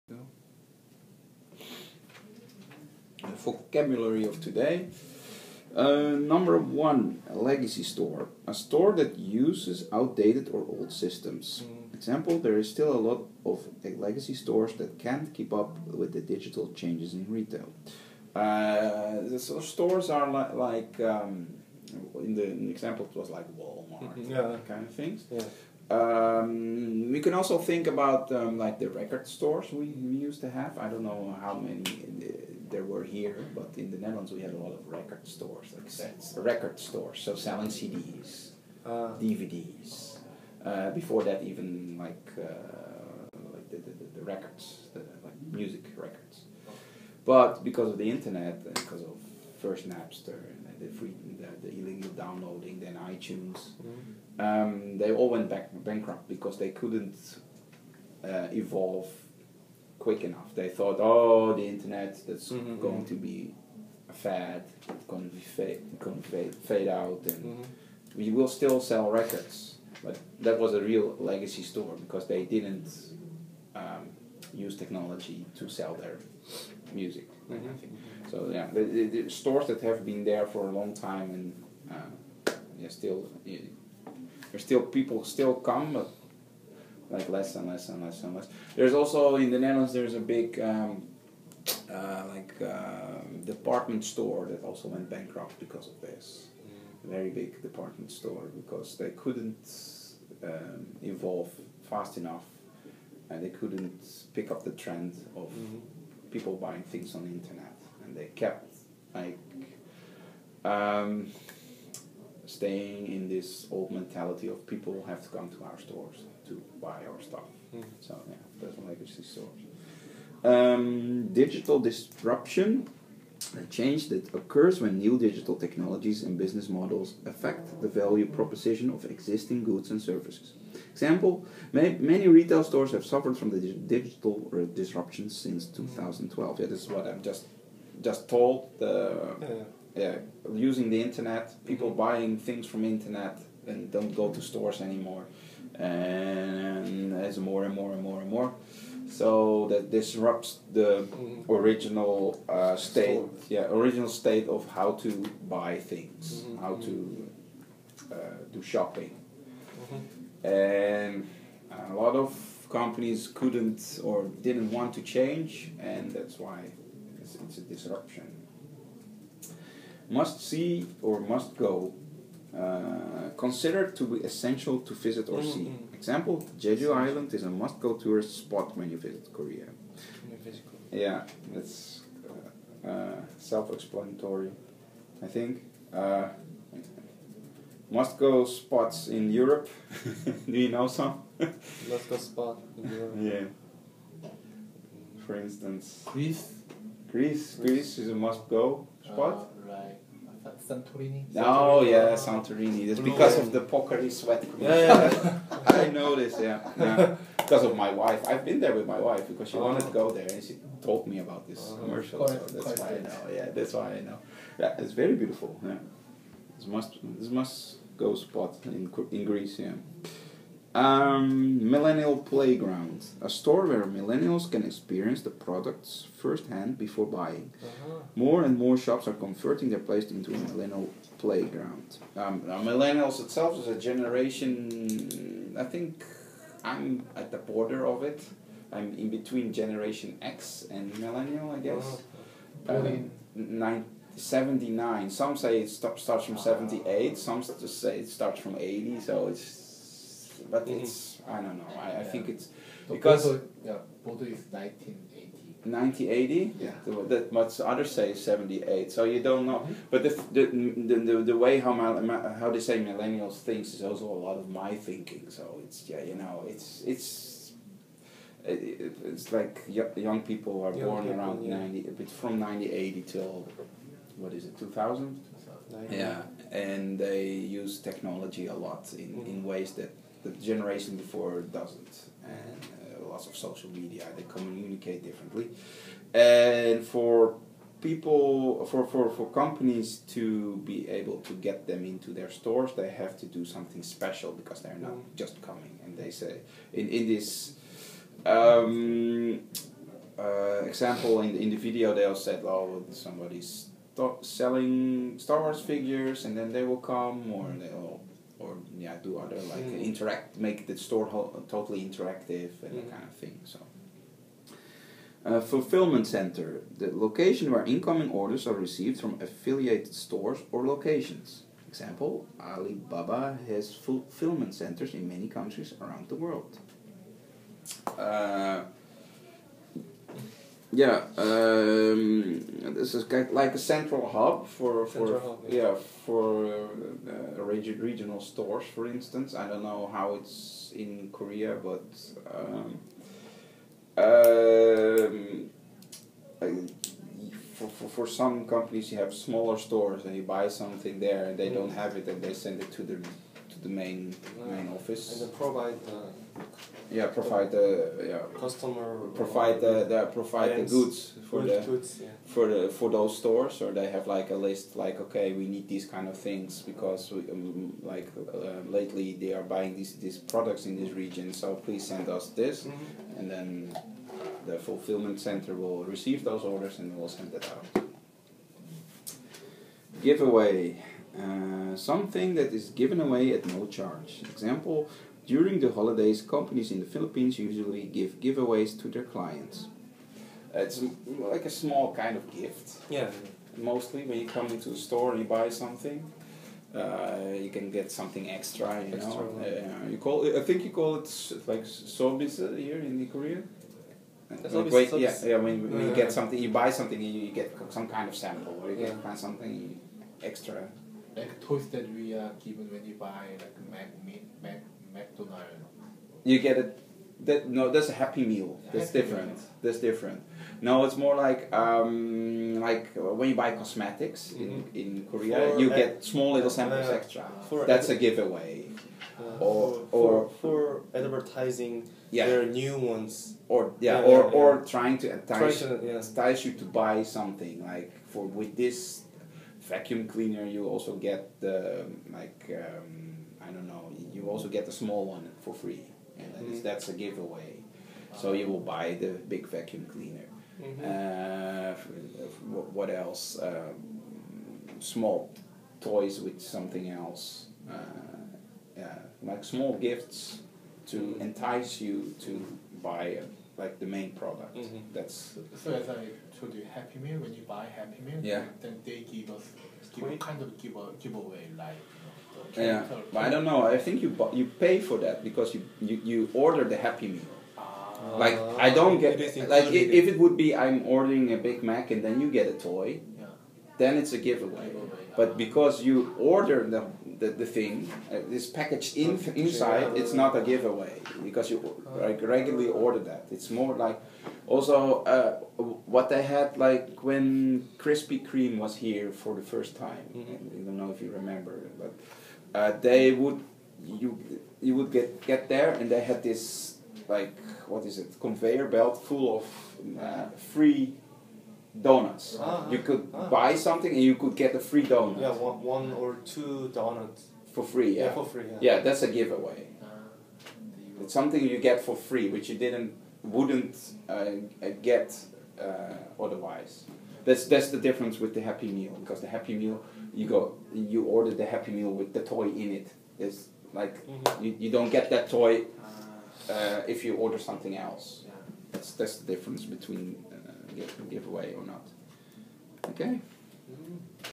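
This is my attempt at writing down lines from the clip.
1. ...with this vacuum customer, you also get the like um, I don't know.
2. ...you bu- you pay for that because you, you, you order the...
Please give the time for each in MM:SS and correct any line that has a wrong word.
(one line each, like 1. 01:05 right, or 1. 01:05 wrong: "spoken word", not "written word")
1. 07:18 wrong: "cleaner", not "customer"
2. 07:54 right.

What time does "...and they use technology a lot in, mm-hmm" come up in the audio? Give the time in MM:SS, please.
04:36.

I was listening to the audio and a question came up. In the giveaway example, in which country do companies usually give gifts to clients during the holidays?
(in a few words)
the Philippines.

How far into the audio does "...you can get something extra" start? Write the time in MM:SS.
06:37.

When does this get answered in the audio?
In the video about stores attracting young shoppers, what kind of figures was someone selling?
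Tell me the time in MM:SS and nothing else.
05:05.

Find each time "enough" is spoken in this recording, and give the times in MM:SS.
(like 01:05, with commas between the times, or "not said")
01:00, 01:42.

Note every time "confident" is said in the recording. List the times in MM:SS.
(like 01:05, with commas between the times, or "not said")
not said.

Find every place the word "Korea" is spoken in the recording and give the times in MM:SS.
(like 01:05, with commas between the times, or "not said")
02:59, 05:41, 06:43, 07:05.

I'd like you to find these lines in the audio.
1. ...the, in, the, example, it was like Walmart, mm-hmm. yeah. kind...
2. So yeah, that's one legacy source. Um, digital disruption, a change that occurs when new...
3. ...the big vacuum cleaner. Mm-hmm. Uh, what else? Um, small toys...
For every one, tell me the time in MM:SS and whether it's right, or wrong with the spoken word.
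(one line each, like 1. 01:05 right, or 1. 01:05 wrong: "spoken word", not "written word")
1. 00:22 right
2. 01:58 right
3. 07:28 right.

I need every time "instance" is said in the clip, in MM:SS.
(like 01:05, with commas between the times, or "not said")
03:15, 05:38.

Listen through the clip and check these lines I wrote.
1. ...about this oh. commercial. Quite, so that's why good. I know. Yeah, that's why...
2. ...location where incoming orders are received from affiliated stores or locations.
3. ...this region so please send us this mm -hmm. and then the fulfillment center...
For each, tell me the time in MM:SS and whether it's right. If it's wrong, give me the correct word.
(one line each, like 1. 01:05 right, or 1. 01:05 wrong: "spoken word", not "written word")
1. 03:31 right
2. 05:16 right
3. 06:10 right.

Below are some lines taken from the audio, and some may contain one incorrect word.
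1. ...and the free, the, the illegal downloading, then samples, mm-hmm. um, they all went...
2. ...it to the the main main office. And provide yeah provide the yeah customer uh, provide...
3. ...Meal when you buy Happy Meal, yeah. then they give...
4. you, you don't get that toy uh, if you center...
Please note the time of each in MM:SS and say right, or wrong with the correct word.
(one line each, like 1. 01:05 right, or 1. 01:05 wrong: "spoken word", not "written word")
1. 00:50 wrong: "iTunes", not "samples"
2. 05:52 right
3. 07:47 right
4. 08:54 wrong: "order", not "center".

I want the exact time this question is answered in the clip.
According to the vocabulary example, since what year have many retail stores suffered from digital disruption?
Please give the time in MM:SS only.
02:15.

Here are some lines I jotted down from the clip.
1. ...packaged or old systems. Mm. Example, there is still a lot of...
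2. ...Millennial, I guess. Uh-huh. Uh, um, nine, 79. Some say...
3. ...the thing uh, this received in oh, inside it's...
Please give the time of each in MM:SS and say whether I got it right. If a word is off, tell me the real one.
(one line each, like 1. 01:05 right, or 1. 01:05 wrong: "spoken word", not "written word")
1. 00:09 wrong: "outdated", not "packaged"
2. 04:00 right
3. 08:07 wrong: "packaged", not "received".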